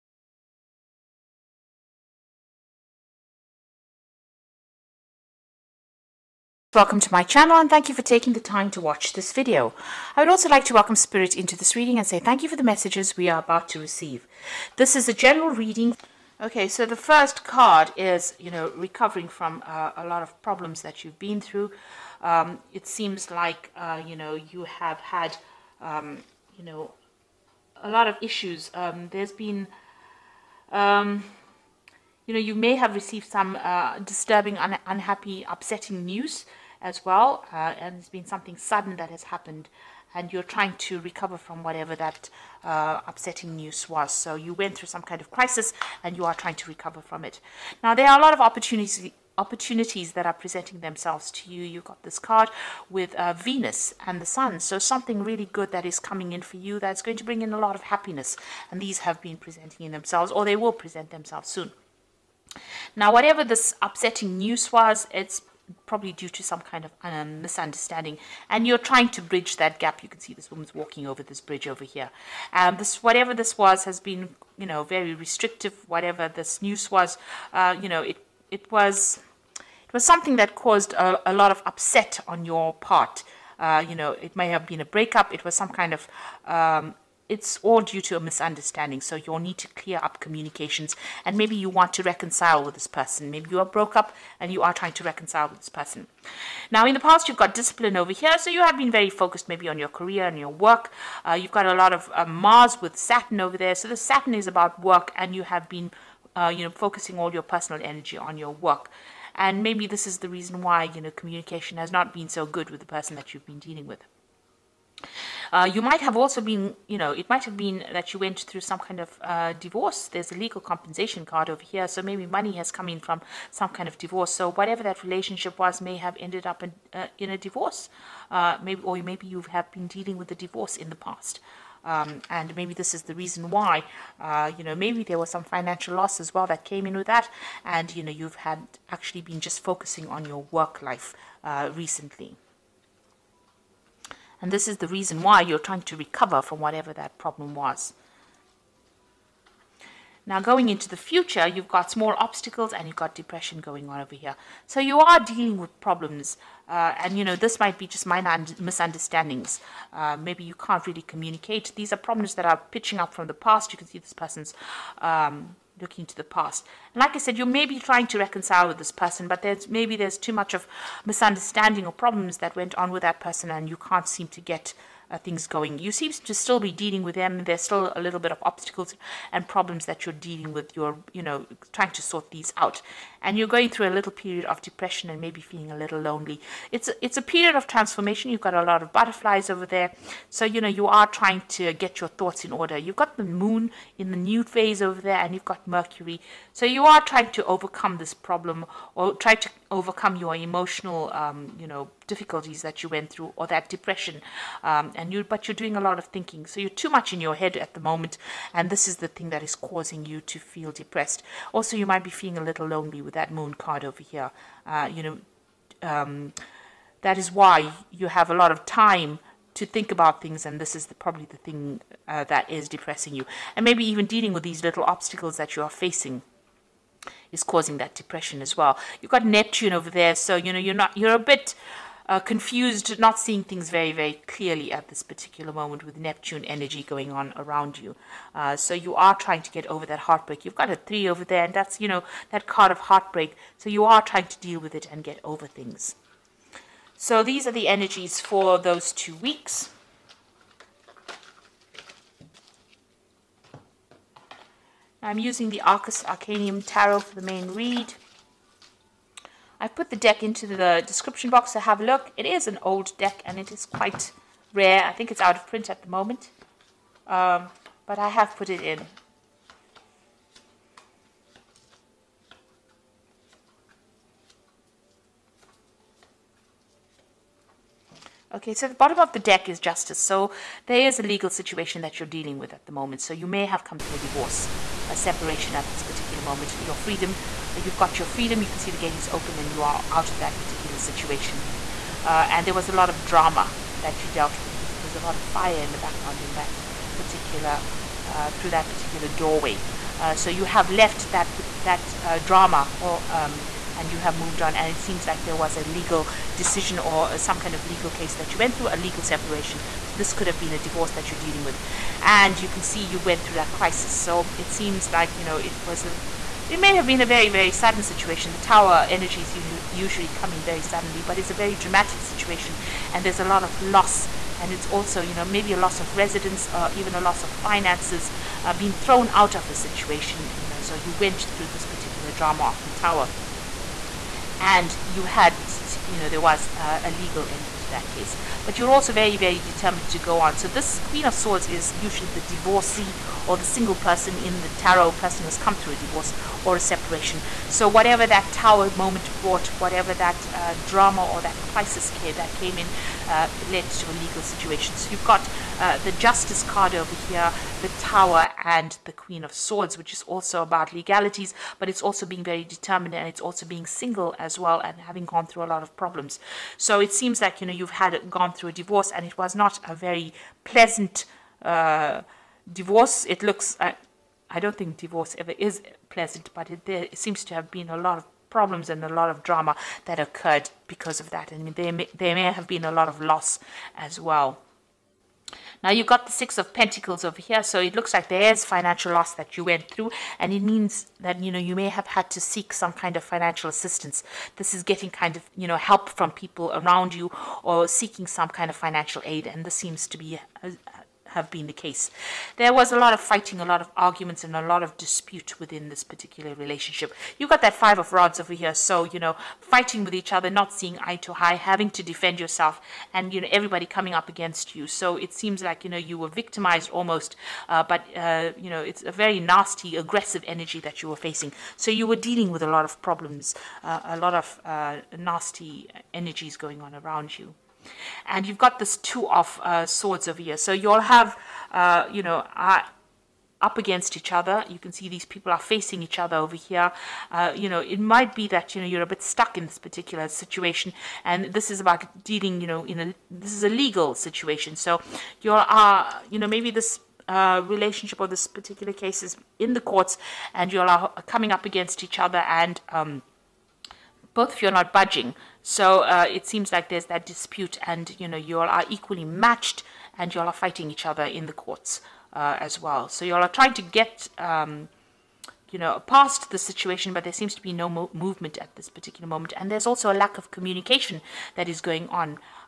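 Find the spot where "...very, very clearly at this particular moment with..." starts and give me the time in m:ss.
3:53.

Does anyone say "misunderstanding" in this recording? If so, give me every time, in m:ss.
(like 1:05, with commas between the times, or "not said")
1:07, 1:28, 2:38, 2:51.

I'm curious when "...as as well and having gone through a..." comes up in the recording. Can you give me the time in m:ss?
6:04.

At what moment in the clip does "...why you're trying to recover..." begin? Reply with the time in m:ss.
2:25.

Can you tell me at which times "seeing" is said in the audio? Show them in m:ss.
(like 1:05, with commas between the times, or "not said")
3:53, 6:50.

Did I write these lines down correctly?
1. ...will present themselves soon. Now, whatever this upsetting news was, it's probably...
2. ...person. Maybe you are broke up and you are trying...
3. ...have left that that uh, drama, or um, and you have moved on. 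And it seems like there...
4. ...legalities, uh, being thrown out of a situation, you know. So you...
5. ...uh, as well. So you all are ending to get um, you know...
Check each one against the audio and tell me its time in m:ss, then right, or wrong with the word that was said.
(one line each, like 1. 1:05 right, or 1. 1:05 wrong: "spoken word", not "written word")
1. 1:00 right
2. 1:32 right
3. 5:00 right
4. 5:27 wrong: "finances", not "legalities"
5. 7:42 wrong: "trying", not "ending".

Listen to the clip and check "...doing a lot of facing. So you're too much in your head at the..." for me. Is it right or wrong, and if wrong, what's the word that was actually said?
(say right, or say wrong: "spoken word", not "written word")
wrong: "thinking", not "facing".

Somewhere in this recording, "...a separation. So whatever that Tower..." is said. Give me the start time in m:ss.
5:46.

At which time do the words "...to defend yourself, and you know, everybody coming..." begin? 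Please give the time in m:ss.
6:51.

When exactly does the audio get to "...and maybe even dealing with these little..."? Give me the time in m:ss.
3:43.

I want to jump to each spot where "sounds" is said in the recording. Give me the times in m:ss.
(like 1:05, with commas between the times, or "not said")
not said.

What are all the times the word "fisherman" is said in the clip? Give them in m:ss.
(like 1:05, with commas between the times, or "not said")
not said.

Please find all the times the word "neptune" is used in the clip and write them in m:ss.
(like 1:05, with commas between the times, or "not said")
3:49, 3:55.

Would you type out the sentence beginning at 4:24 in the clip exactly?
I think it's out of print at the moment.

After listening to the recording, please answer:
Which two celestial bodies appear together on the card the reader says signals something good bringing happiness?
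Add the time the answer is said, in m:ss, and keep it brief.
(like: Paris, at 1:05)
Venus and the Sun, at 0:53.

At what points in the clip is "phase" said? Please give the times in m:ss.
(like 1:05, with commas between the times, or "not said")
3:14.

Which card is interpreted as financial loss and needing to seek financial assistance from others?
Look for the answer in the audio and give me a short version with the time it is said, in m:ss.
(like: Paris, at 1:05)
Six of Pentacles, at 6:26.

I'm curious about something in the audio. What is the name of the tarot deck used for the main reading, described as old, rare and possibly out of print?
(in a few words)
Arcus Arcanum Tarot.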